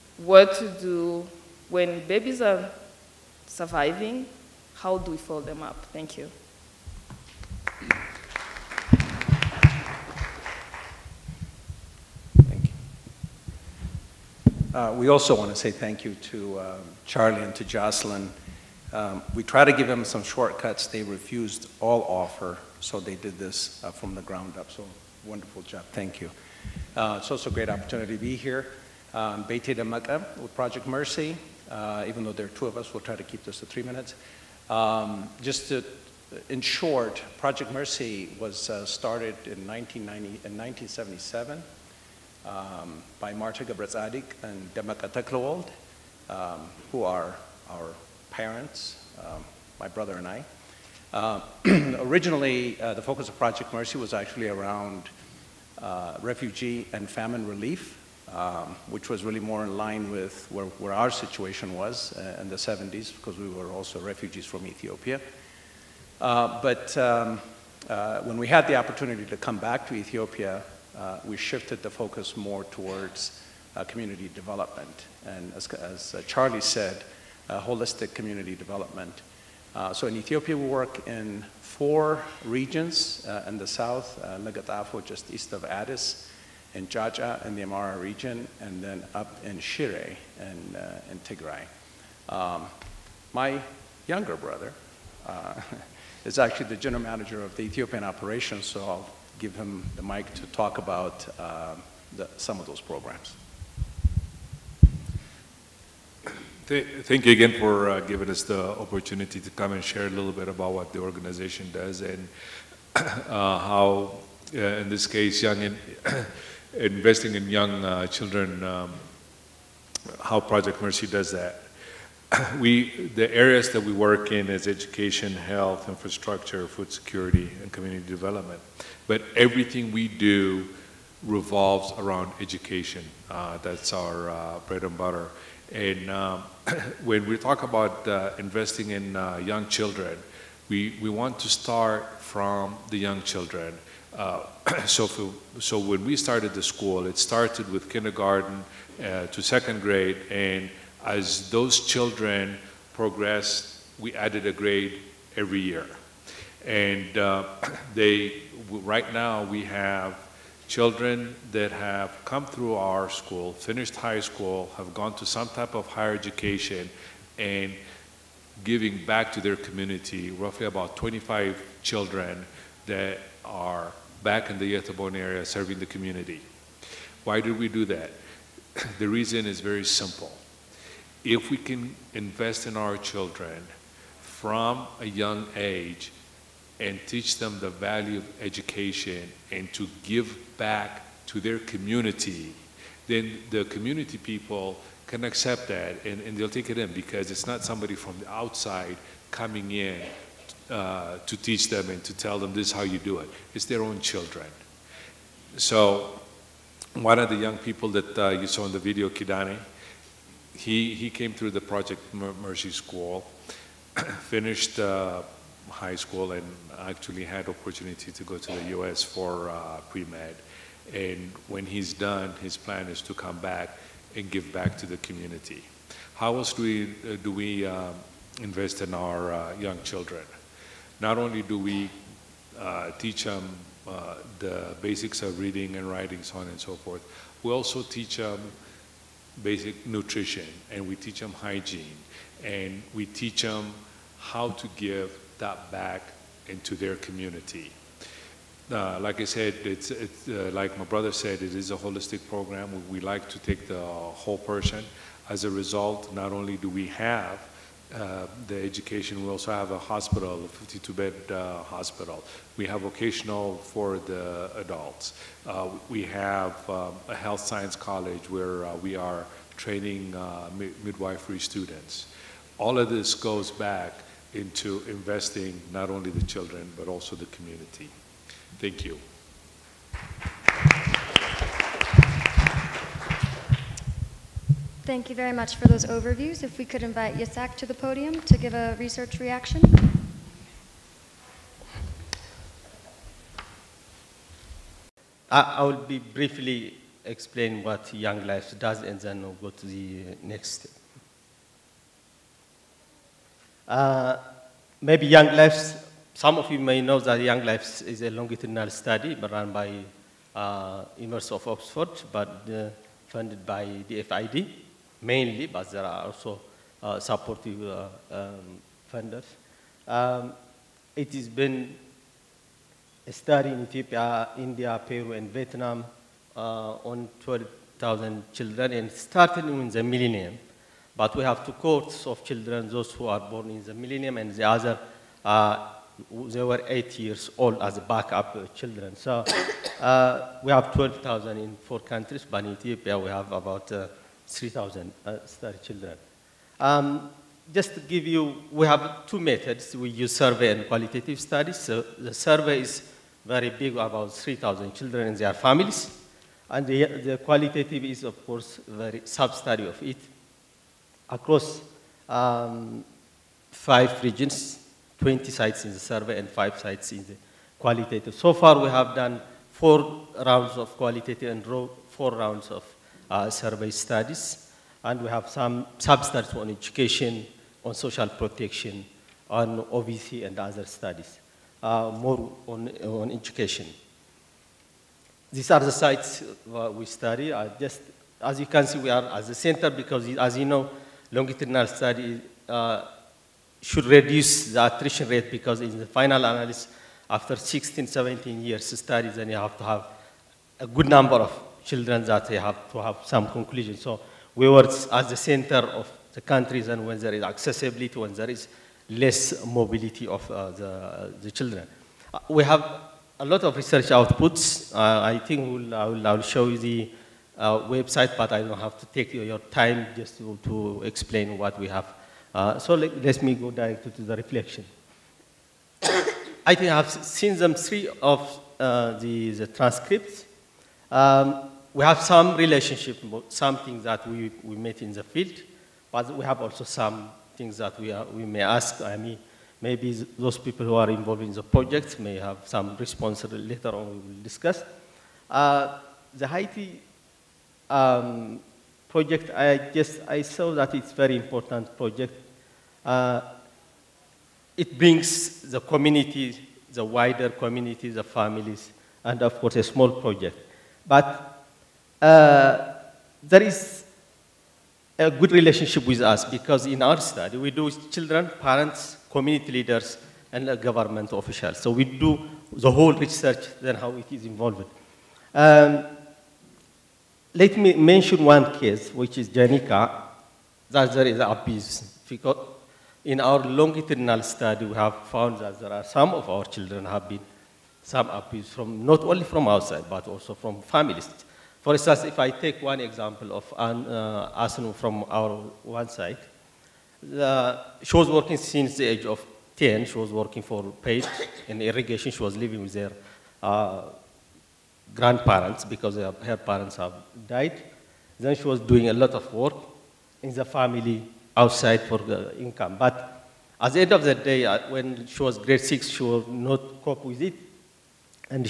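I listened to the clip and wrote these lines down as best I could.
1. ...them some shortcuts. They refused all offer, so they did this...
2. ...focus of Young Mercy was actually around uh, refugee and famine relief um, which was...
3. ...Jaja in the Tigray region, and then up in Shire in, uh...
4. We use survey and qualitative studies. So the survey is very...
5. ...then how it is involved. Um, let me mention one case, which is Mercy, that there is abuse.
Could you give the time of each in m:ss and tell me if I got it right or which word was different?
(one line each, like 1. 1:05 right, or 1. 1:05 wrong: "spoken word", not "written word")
1. 0:19 right
2. 0:53 wrong: "Project", not "Young"
3. 1:26 wrong: "Amhara", not "Tigray"
4. 5:49 right
5. 7:53 wrong: "Janica", not "Mercy".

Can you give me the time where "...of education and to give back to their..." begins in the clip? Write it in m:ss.
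3:08.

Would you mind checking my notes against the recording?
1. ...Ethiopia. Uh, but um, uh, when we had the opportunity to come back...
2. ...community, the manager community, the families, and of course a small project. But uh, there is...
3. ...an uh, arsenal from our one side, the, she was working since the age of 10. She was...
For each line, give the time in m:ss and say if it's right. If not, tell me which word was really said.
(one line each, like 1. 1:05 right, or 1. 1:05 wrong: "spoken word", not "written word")
1. 1:04 right
2. 7:35 wrong: "wider", not "manager"
3. 8:13 right.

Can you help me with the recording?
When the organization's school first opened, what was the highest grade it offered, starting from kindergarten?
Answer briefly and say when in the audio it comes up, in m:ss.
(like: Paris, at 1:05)
second grade, at 2:29.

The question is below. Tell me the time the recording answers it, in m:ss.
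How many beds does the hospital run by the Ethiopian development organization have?
4:20.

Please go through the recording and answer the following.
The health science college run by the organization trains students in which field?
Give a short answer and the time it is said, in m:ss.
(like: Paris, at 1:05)
midwifery, at 4:30.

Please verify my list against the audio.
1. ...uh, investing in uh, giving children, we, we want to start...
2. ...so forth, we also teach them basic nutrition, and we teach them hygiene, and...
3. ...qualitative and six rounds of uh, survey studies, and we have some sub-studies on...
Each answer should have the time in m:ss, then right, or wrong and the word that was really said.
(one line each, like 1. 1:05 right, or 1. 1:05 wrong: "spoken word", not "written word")
1. 2:18 wrong: "young", not "giving"
2. 3:56 right
3. 6:10 wrong: "four", not "six".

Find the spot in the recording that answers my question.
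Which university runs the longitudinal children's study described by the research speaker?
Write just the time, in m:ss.
5:10.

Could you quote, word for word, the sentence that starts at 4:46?
If we could invite Yisak to the podium to give a research reaction.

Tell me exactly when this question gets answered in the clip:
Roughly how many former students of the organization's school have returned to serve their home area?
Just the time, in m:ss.
2:50.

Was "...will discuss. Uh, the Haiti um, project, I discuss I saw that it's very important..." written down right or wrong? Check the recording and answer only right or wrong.
wrong.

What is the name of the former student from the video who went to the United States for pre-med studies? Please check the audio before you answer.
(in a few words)
Kidani.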